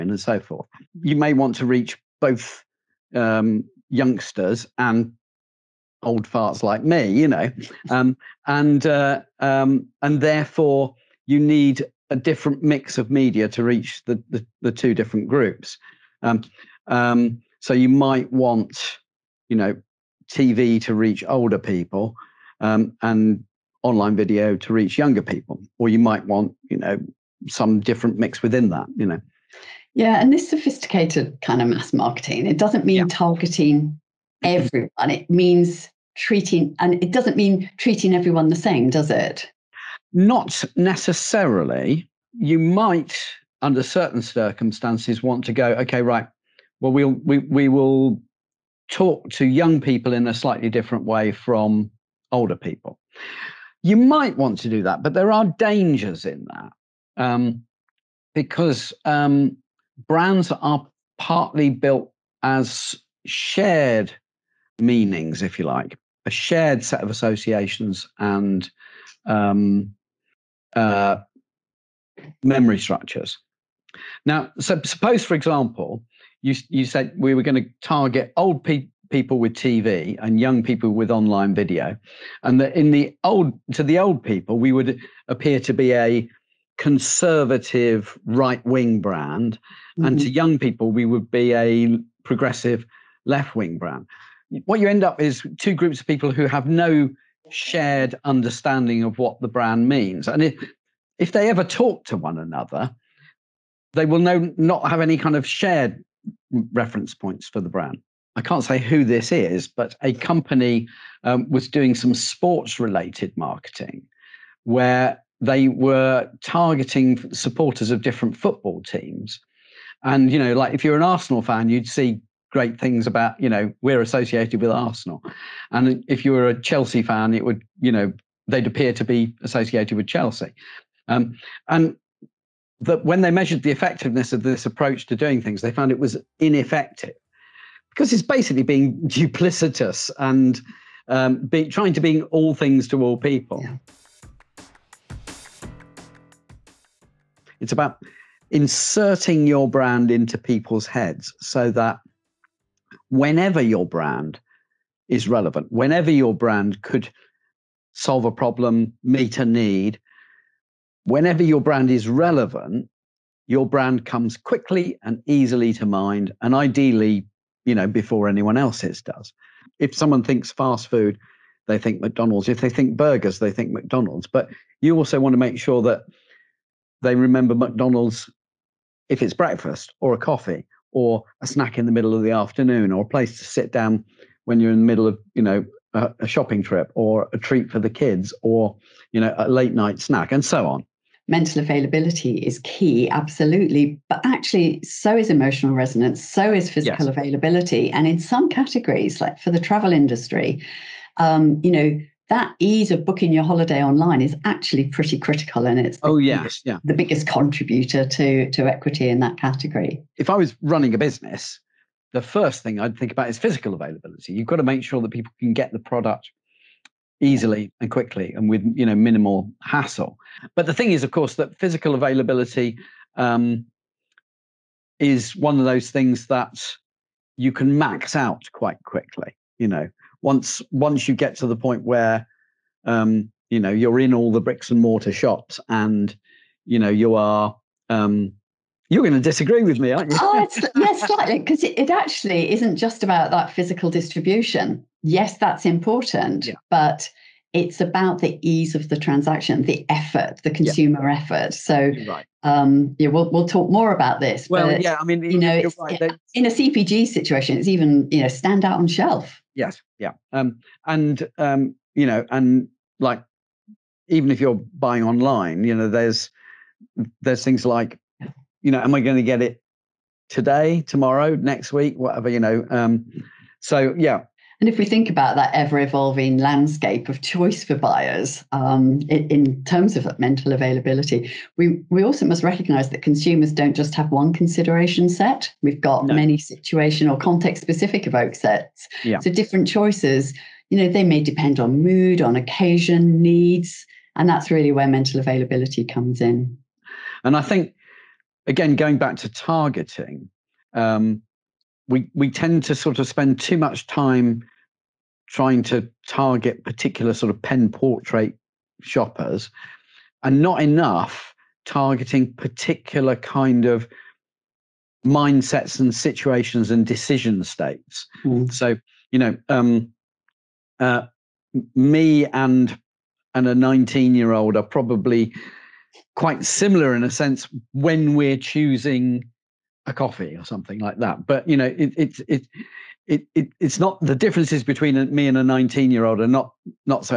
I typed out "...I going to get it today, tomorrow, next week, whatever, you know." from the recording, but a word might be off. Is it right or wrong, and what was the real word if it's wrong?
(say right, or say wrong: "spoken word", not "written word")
right.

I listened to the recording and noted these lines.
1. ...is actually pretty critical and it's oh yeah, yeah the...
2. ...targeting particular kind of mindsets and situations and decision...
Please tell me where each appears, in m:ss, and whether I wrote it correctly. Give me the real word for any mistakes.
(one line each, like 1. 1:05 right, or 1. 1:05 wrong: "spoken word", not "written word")
1. 3:24 right
2. 5:11 right.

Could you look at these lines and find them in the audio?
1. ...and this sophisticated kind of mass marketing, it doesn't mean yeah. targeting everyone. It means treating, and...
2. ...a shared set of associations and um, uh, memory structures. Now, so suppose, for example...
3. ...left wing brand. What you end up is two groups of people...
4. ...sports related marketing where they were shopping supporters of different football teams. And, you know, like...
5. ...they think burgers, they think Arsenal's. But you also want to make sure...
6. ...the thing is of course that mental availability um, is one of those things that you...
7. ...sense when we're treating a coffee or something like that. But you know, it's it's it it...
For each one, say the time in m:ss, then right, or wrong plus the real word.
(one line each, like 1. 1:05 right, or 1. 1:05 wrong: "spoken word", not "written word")
1. 0:30 right
2. 1:06 right
3. 1:33 right
4. 1:52 wrong: "targeting", not "shopping"
5. 2:52 wrong: "McDonald", not "Arsenal"
6. 3:40 wrong: "physical", not "mental"
7. 5:27 wrong: "choosing", not "treating".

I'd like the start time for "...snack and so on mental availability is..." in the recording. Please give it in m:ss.
3:09.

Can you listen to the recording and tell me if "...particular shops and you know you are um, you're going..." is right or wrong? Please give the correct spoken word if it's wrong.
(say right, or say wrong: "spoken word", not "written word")
wrong: "mortar", not "particular".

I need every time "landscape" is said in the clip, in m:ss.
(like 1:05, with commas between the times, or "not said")
4:36.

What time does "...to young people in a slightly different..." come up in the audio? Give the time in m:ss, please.
0:49.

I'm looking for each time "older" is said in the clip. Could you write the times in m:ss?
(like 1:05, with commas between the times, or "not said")
0:21, 0:52.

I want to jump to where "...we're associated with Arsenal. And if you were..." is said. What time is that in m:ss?
2:03.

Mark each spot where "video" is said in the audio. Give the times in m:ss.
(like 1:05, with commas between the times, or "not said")
0:24, 1:21.